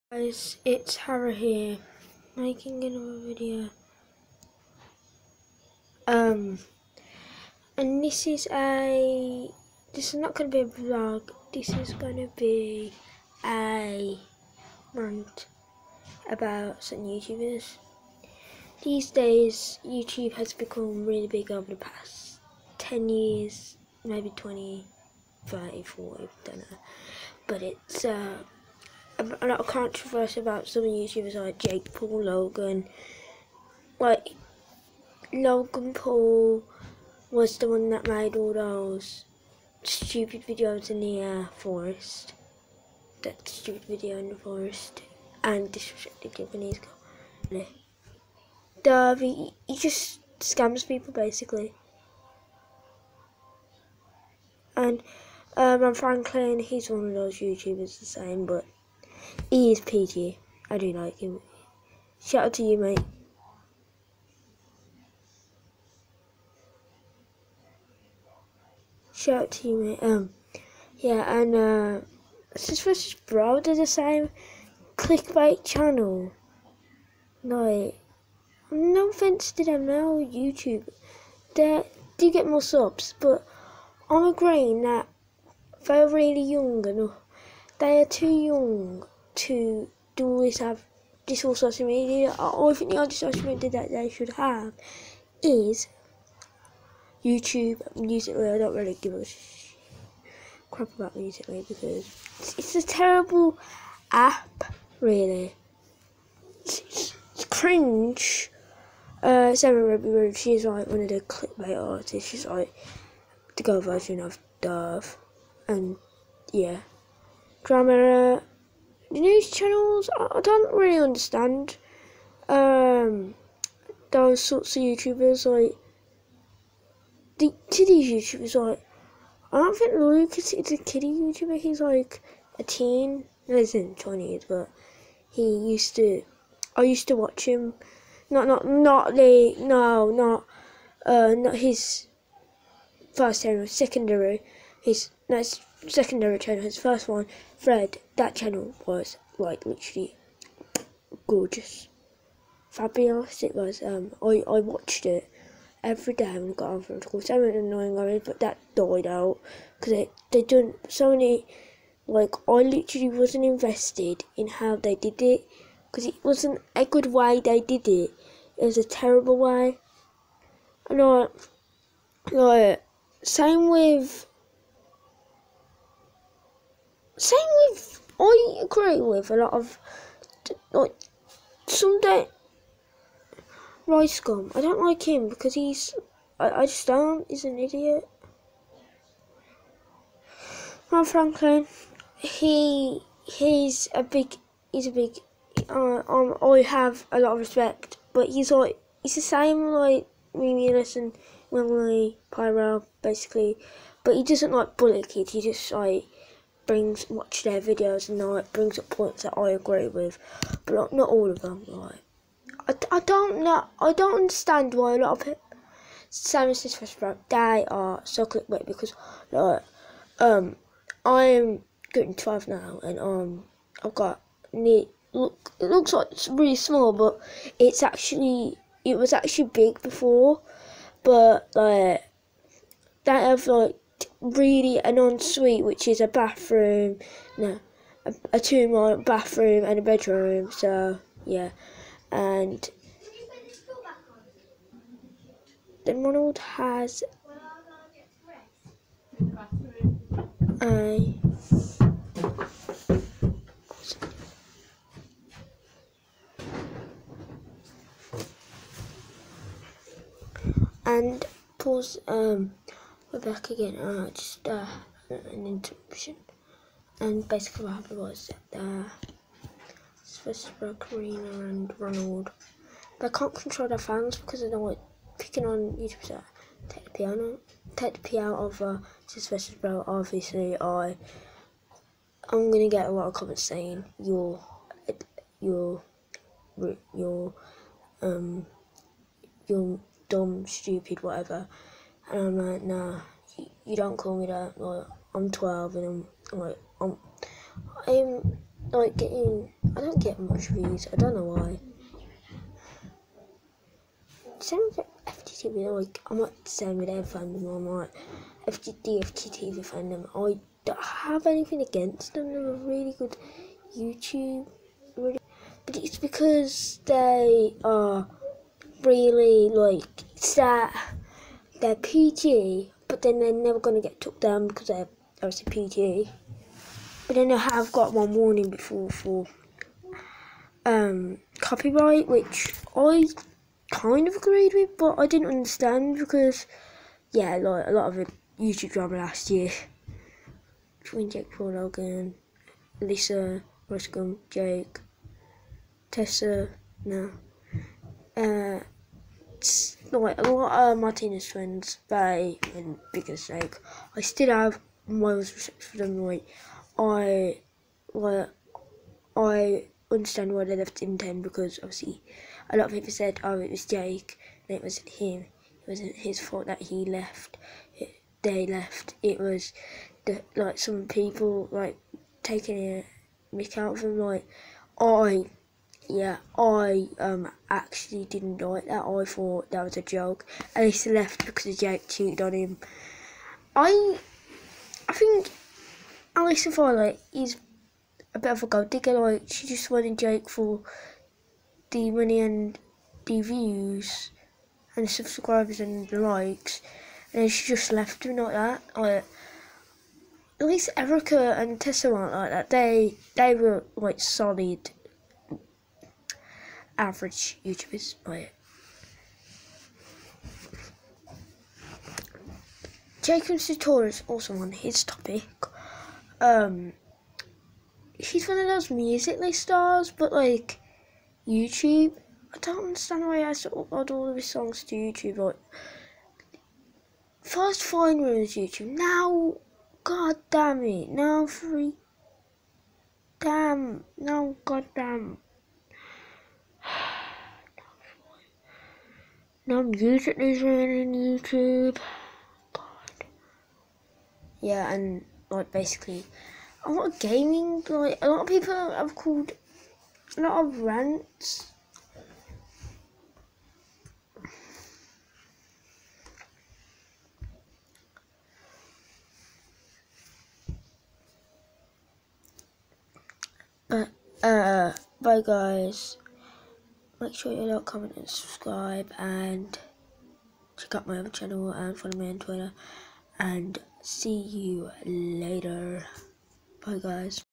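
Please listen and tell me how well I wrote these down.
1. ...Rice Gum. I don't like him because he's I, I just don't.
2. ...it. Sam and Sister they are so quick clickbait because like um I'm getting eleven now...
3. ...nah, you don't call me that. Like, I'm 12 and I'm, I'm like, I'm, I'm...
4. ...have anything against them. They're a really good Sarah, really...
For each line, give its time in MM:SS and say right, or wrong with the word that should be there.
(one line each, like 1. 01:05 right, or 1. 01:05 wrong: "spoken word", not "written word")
1. 03:03 right
2. 03:35 wrong: "twelve", not "eleven"
3. 04:52 right
4. 05:10 wrong: "YouTube", not "Sarah".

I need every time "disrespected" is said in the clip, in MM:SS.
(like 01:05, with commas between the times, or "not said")
00:45.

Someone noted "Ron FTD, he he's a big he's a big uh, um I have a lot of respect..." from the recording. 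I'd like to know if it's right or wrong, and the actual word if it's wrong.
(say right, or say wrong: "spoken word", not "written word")
wrong: "Franklin", not "FTD".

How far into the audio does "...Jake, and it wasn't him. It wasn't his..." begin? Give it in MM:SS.
06:03.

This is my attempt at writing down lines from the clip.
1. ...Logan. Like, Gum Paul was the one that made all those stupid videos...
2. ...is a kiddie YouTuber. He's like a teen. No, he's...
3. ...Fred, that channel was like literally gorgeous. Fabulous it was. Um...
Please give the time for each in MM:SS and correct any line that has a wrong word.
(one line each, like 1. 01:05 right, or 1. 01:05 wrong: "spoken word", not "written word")
1. 00:32 wrong: "Logan", not "Gum"
2. 02:10 right
3. 02:27 right.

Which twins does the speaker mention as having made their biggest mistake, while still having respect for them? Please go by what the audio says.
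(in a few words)
Martinez twins.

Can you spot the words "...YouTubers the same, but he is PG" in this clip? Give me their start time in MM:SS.
00:57.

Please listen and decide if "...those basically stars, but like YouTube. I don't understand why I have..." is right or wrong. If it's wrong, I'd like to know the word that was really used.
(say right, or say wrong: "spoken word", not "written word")
wrong: "musically", not "basically".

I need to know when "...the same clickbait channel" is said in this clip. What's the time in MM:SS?
01:13.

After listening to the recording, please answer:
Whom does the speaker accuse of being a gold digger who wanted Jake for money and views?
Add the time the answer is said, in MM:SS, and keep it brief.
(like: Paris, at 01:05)
Alyssa Violet, at 06:26.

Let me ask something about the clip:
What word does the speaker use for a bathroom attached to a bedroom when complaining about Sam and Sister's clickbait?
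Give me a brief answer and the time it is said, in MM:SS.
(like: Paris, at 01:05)
ensuite, at 03:54.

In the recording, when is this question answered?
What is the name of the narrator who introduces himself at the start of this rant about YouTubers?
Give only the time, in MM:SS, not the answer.
00:00.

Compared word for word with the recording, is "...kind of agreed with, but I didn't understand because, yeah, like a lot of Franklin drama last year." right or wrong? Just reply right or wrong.
wrong.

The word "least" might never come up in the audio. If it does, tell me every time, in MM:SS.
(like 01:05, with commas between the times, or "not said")
06:40.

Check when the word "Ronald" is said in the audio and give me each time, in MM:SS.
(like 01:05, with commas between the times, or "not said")
04:06, 04:31.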